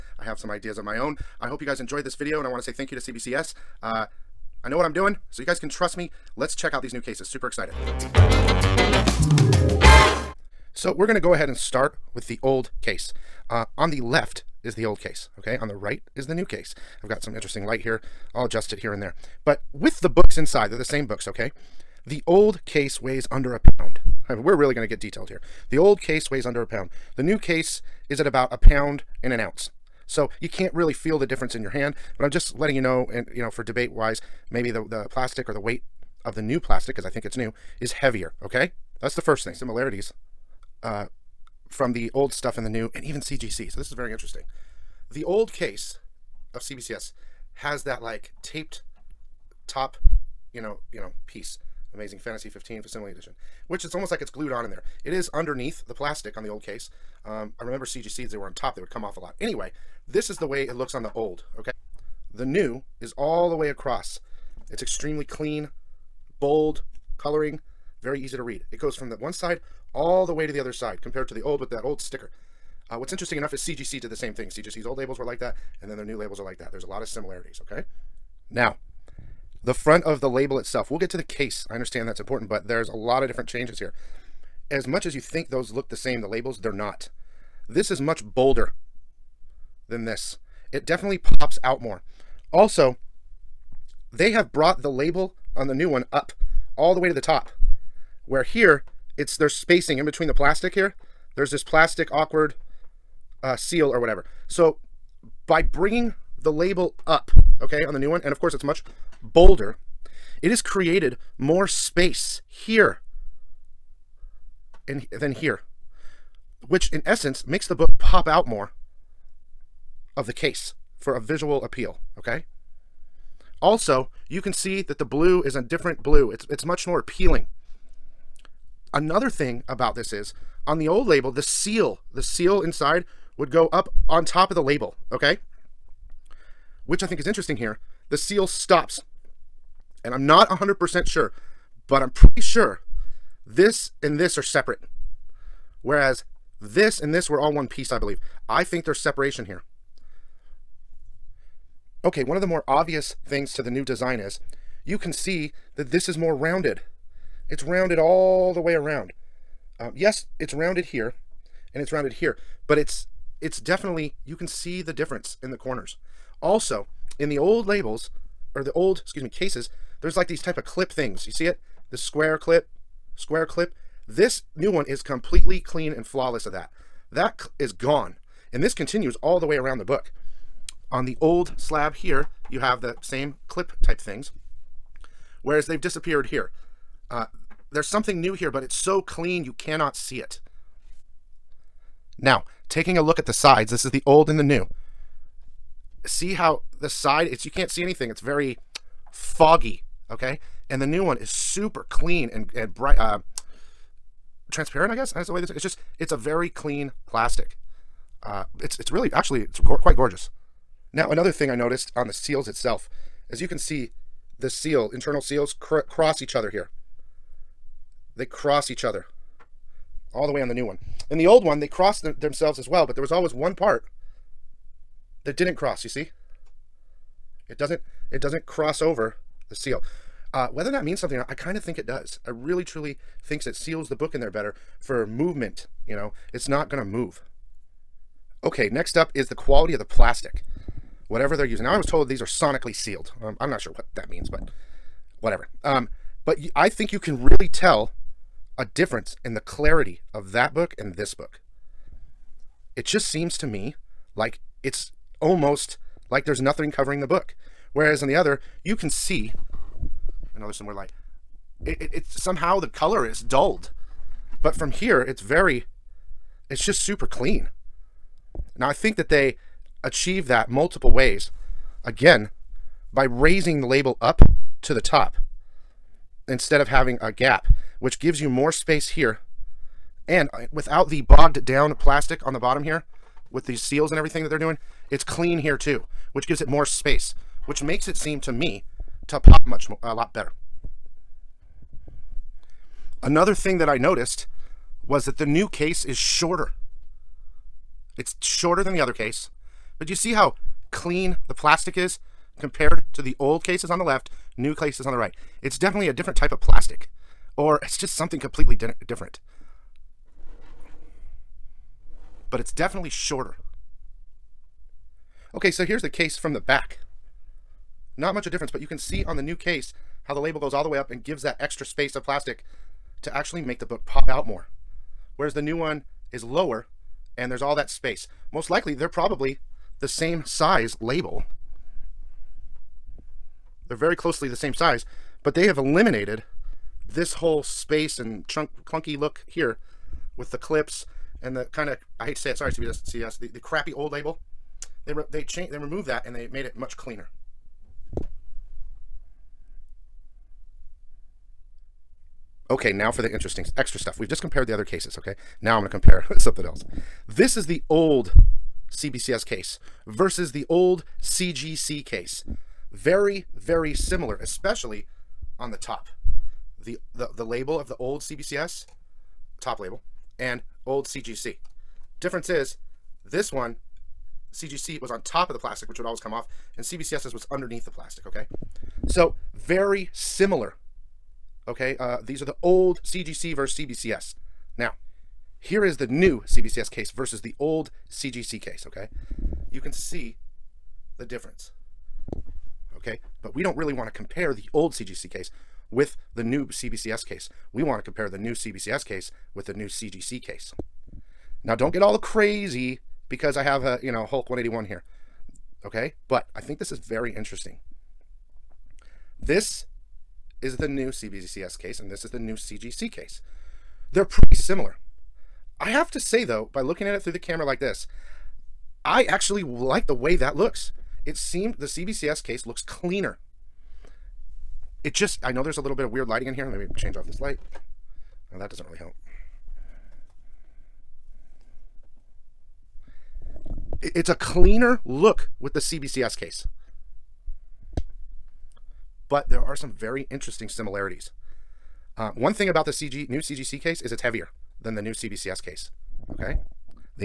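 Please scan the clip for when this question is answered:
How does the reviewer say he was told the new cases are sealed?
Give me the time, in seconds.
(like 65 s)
242 s.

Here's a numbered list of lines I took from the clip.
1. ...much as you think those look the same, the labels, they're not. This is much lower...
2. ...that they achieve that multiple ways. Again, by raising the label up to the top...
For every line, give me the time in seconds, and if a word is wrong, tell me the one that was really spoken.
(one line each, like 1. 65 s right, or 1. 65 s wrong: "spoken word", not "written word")
1. 84 s wrong: "bolder", not "lower"
2. 268 s right.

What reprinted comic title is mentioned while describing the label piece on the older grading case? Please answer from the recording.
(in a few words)
Amazing Fantasy 15 Facsimile Edition.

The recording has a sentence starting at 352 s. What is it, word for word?
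Okay, now for the interesting extra stuff.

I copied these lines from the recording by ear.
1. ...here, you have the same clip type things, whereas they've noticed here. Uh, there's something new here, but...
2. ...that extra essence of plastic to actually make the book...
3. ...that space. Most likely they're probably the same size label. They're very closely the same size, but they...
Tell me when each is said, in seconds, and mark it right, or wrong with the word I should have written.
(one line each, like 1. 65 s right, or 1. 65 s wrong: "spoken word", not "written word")
1. 181 s wrong: "disappeared", not "noticed"
2. 321 s wrong: "space", not "essence"
3. 327 s right.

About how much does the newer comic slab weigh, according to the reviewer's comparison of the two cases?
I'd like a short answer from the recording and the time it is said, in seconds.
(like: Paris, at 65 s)
a pound and an ounce, at 28 s.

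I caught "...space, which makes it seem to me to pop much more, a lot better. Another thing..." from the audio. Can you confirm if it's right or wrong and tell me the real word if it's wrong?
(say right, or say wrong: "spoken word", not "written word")
right.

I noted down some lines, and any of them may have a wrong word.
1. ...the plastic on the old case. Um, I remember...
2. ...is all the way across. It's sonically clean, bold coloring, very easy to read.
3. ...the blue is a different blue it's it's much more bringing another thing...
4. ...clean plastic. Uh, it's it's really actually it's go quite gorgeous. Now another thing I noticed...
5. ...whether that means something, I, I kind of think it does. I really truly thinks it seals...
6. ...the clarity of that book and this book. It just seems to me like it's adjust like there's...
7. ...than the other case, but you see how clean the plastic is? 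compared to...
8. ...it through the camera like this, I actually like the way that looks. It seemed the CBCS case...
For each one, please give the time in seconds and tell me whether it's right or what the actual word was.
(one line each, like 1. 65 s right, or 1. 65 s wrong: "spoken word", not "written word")
1. 55 s right
2. 63 s wrong: "extremely", not "sonically"
3. 124 s wrong: "appealing", not "bringing"
4. 206 s right
5. 230 s right
6. 249 s wrong: "almost", not "adjust"
7. 298 s right
8. 416 s right.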